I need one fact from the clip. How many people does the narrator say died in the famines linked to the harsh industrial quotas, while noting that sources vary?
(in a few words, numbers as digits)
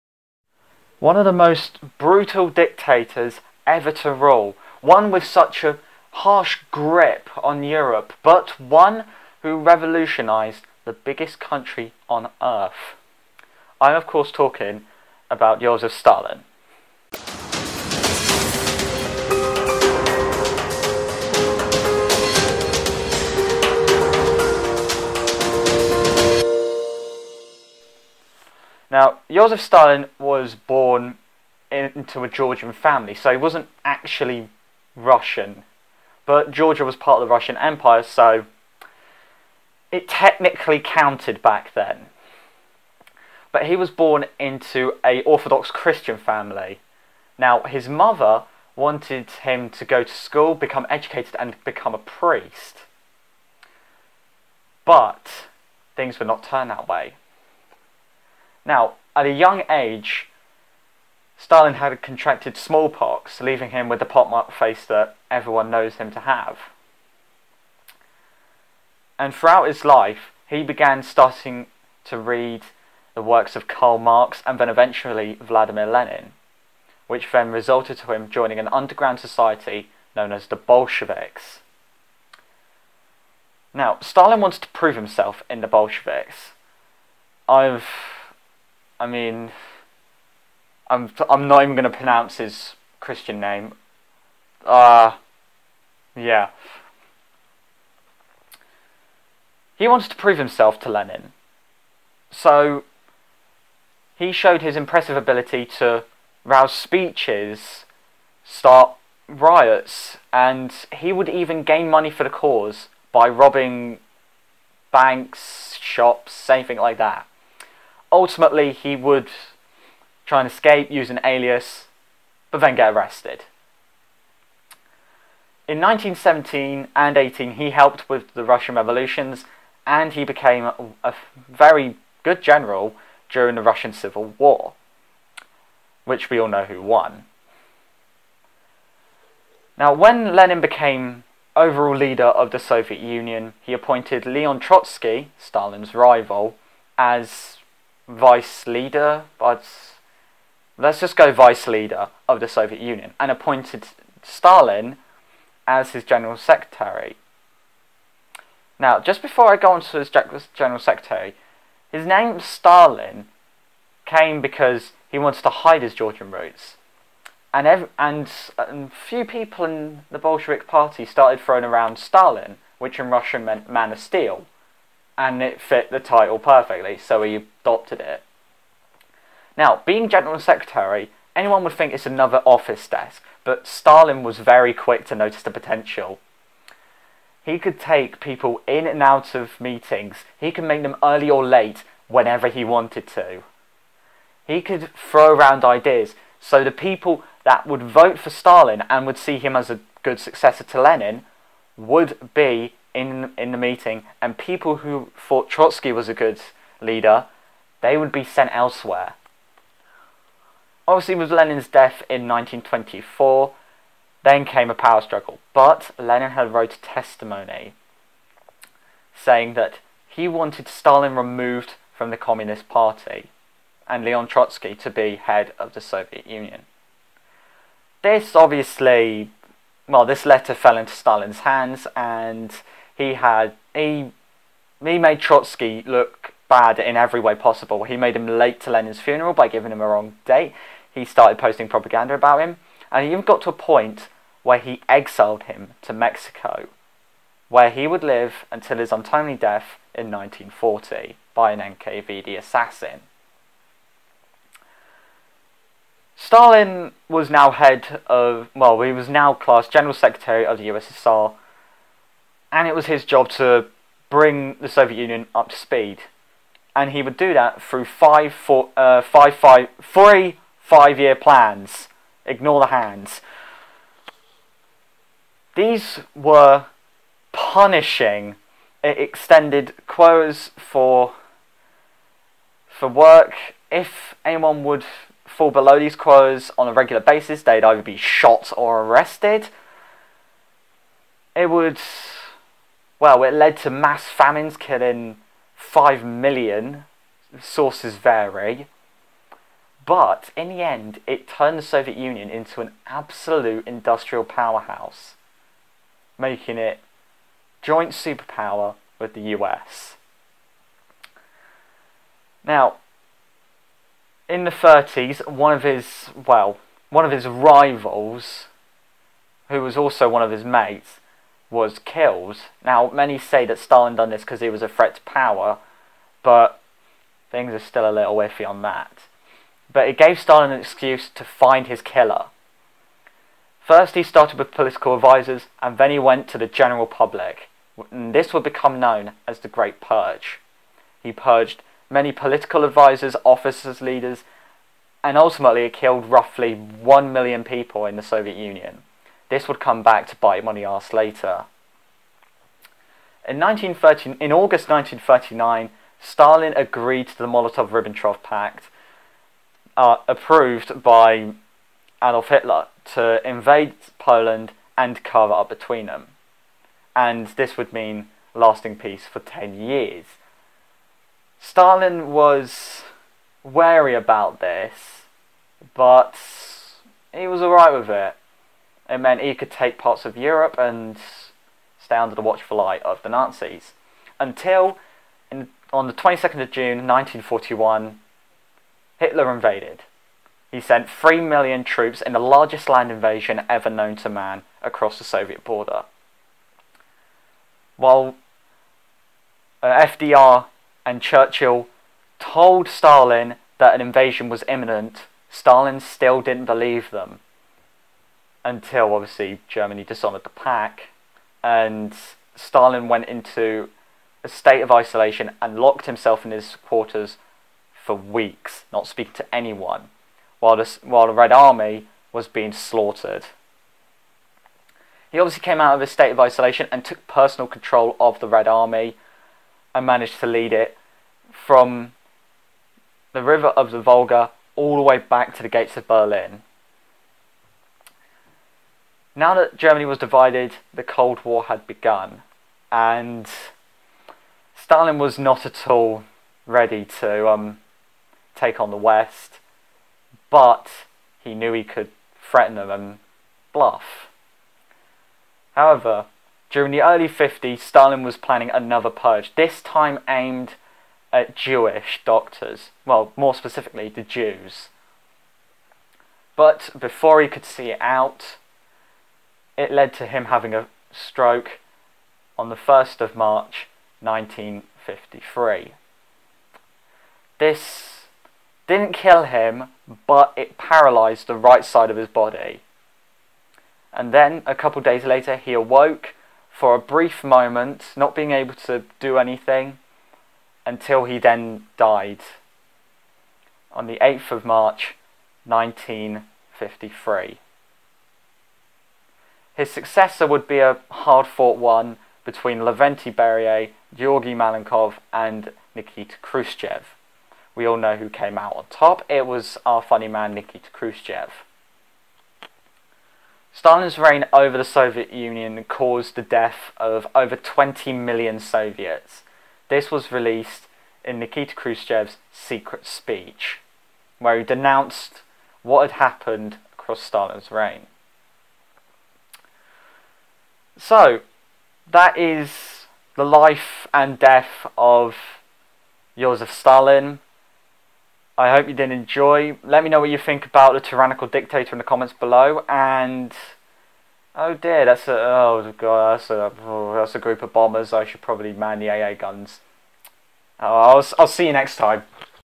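5 million.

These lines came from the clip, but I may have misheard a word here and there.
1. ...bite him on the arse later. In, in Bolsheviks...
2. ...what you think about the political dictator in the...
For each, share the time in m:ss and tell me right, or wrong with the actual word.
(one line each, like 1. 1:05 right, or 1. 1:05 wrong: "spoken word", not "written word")
1. 5:50 wrong: "August", not "Bolsheviks"
2. 8:59 wrong: "tyrannical", not "political".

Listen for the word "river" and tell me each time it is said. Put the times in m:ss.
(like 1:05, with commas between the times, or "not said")
7:13.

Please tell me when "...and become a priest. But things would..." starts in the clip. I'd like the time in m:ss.
0:51.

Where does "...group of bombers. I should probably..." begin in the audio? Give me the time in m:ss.
9:07.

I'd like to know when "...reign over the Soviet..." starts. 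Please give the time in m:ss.
8:33.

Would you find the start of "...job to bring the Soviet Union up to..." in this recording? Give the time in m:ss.
4:23.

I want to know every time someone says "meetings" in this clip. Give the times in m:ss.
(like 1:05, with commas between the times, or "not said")
3:09, 3:23.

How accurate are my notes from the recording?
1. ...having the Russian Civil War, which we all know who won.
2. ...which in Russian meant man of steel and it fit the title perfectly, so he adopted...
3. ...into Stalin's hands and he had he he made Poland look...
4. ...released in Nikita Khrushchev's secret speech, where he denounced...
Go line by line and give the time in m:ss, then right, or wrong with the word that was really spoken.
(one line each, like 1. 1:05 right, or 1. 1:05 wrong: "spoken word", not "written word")
1. 2:13 wrong: "during", not "having"
2. 2:52 right
3. 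3:50 wrong: "Trotsky", not "Poland"
4. 8:40 right.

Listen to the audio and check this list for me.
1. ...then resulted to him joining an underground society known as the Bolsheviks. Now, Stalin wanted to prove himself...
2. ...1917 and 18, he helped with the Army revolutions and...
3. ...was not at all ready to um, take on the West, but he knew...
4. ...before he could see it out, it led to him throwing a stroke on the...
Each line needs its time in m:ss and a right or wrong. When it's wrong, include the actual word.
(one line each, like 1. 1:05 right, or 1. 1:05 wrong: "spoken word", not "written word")
1. 1:17 right
2. 2:05 wrong: "Russian", not "Army"
3. 7:24 right
4. 7:46 wrong: "having", not "throwing".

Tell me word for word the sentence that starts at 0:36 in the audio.
But Georgia was part of the Russian Empire, so it technically counted back then.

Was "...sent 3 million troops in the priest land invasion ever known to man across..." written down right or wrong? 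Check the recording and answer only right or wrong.
wrong.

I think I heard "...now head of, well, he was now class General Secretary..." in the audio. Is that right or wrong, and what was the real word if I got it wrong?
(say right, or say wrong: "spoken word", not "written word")
right.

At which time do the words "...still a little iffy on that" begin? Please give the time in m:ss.
5:27.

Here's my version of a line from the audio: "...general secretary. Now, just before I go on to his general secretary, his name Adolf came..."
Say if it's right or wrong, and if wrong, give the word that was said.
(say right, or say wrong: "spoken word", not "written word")
wrong: "Stalin", not "Adolf".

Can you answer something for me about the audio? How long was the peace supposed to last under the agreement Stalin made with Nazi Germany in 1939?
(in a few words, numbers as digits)
10 years.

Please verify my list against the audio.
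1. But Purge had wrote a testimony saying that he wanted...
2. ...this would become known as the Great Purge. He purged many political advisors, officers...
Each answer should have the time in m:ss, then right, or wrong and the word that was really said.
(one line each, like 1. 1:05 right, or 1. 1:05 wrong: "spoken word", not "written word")
1. 3:35 wrong: "Lenin", not "Purge"
2. 5:38 right.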